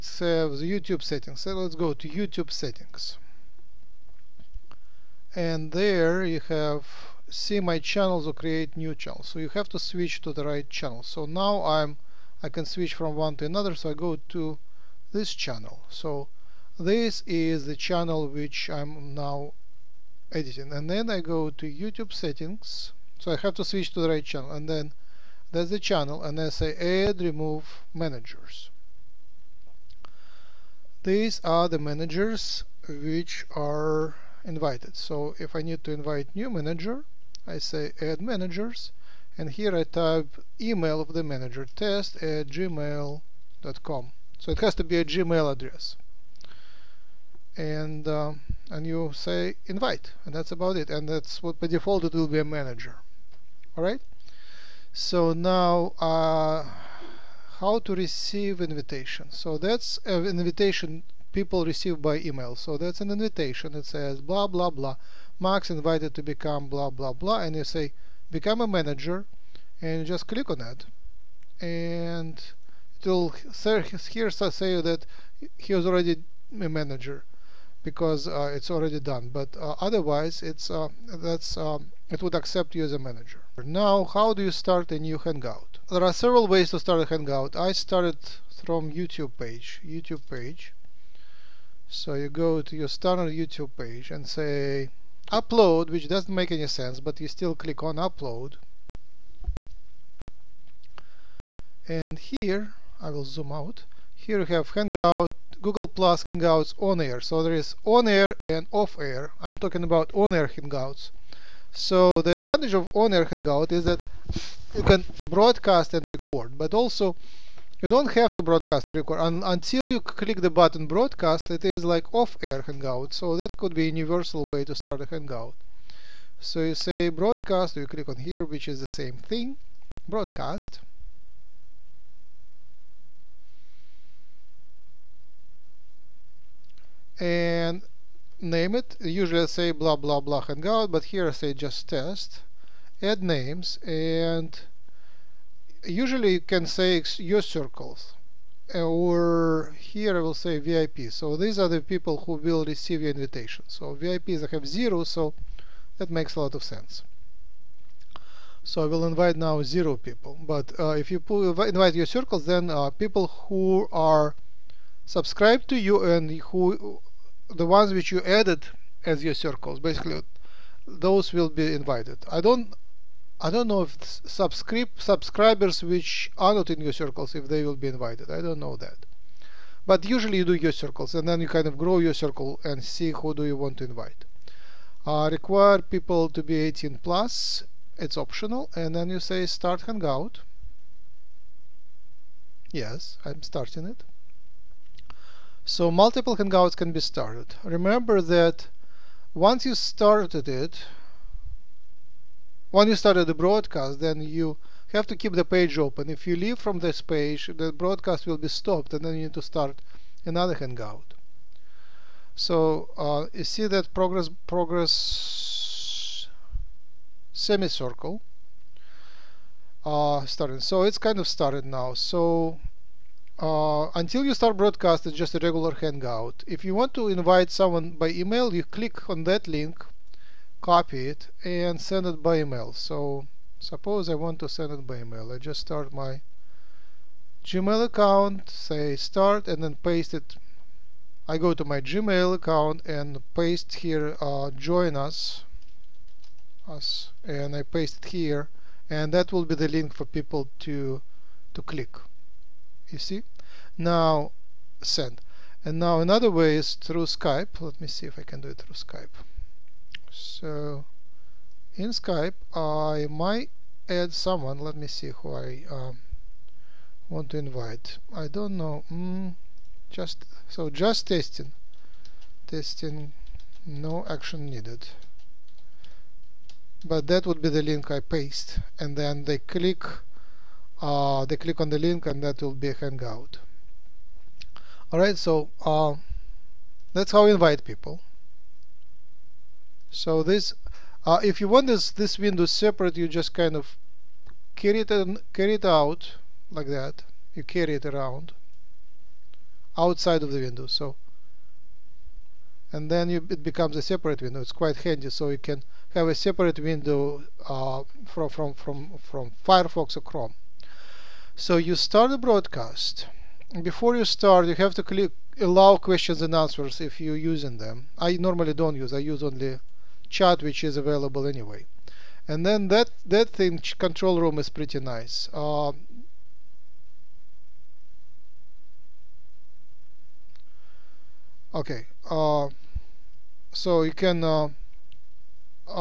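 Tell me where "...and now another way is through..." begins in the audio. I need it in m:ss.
4:15.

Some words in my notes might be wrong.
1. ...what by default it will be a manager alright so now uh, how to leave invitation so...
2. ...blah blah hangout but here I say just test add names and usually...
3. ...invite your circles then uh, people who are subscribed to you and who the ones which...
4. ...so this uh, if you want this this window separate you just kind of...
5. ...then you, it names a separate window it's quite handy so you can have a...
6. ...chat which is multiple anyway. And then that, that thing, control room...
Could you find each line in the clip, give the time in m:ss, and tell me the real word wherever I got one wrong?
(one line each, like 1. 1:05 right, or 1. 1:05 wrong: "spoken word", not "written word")
1. 0:51 wrong: "receive", not "leave"
2. 2:19 right
3. 2:41 right
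4. 4:49 right
5. 5:02 wrong: "becomes", not "names"
6. 5:20 wrong: "available", not "multiple".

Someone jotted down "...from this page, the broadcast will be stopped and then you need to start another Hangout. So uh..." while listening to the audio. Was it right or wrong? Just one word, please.
right.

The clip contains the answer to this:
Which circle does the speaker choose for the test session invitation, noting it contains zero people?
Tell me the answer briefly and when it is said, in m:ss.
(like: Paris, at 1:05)
VIP, at 2:30.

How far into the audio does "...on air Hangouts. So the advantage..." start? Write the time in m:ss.
1:50.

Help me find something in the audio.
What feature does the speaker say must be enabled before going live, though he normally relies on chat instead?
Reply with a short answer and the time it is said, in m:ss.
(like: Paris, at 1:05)
questions and answers, at 5:15.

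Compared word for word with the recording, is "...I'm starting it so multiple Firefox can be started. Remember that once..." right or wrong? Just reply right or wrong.
wrong.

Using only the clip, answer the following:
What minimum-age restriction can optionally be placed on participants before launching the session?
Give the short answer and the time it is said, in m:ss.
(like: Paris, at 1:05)
18 plus, at 3:06.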